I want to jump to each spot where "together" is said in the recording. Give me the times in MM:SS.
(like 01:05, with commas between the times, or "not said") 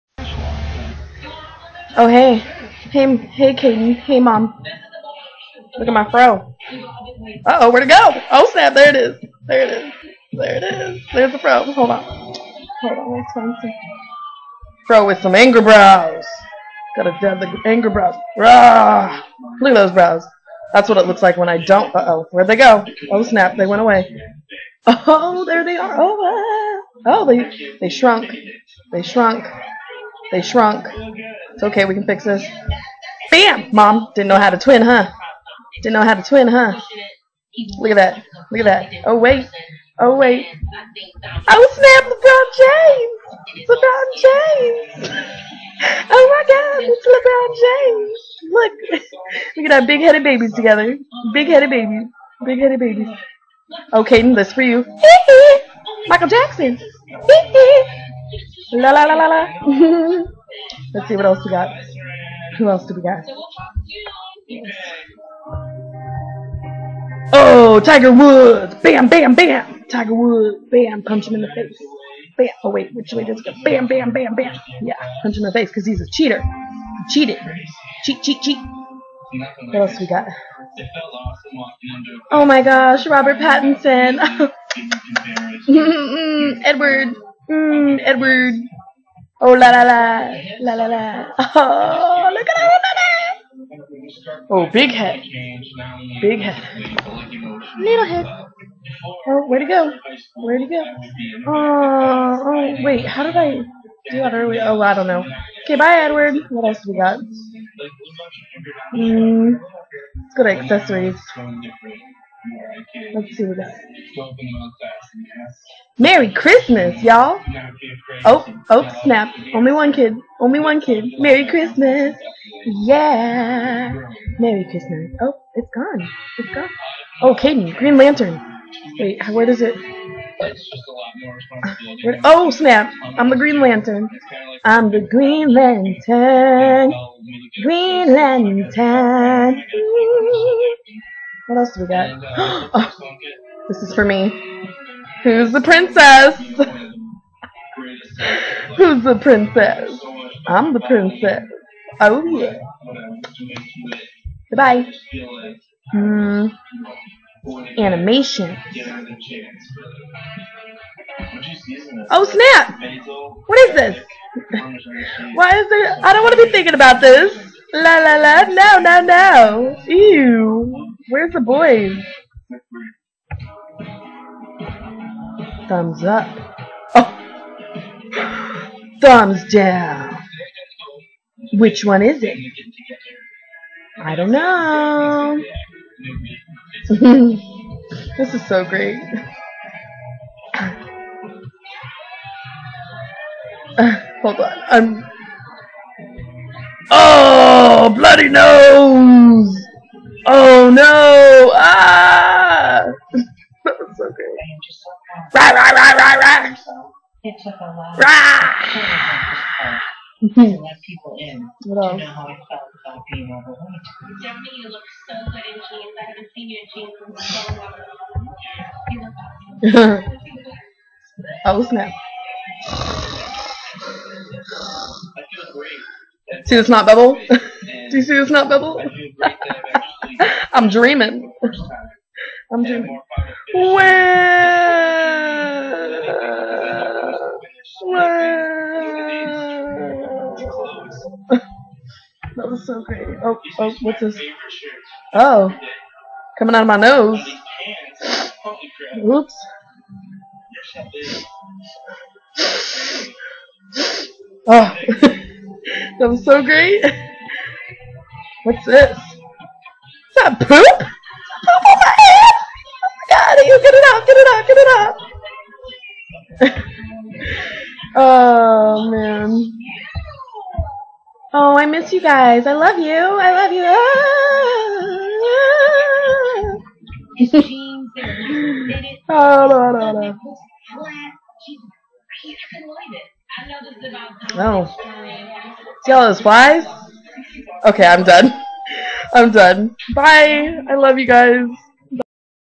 00:50.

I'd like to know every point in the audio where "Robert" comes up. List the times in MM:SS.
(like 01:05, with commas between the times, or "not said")
01:23.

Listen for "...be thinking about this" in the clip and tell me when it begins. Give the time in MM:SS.
02:46.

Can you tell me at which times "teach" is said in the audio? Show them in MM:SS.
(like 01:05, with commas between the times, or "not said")
not said.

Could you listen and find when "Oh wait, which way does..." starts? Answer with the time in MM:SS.
01:12.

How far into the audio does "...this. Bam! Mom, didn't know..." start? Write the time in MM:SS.
00:32.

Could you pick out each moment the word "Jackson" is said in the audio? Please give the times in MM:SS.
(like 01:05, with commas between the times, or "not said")
00:56.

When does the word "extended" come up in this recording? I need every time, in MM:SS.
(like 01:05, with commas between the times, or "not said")
not said.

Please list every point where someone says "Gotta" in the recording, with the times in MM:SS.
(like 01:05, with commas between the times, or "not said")
00:16.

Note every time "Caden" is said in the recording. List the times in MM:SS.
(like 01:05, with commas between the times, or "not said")
00:03, 00:54, 02:07.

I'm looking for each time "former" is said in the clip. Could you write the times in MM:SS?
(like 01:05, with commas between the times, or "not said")
not said.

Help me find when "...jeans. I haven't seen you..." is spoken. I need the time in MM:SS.
03:35.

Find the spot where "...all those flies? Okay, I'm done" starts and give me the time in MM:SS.
04:45.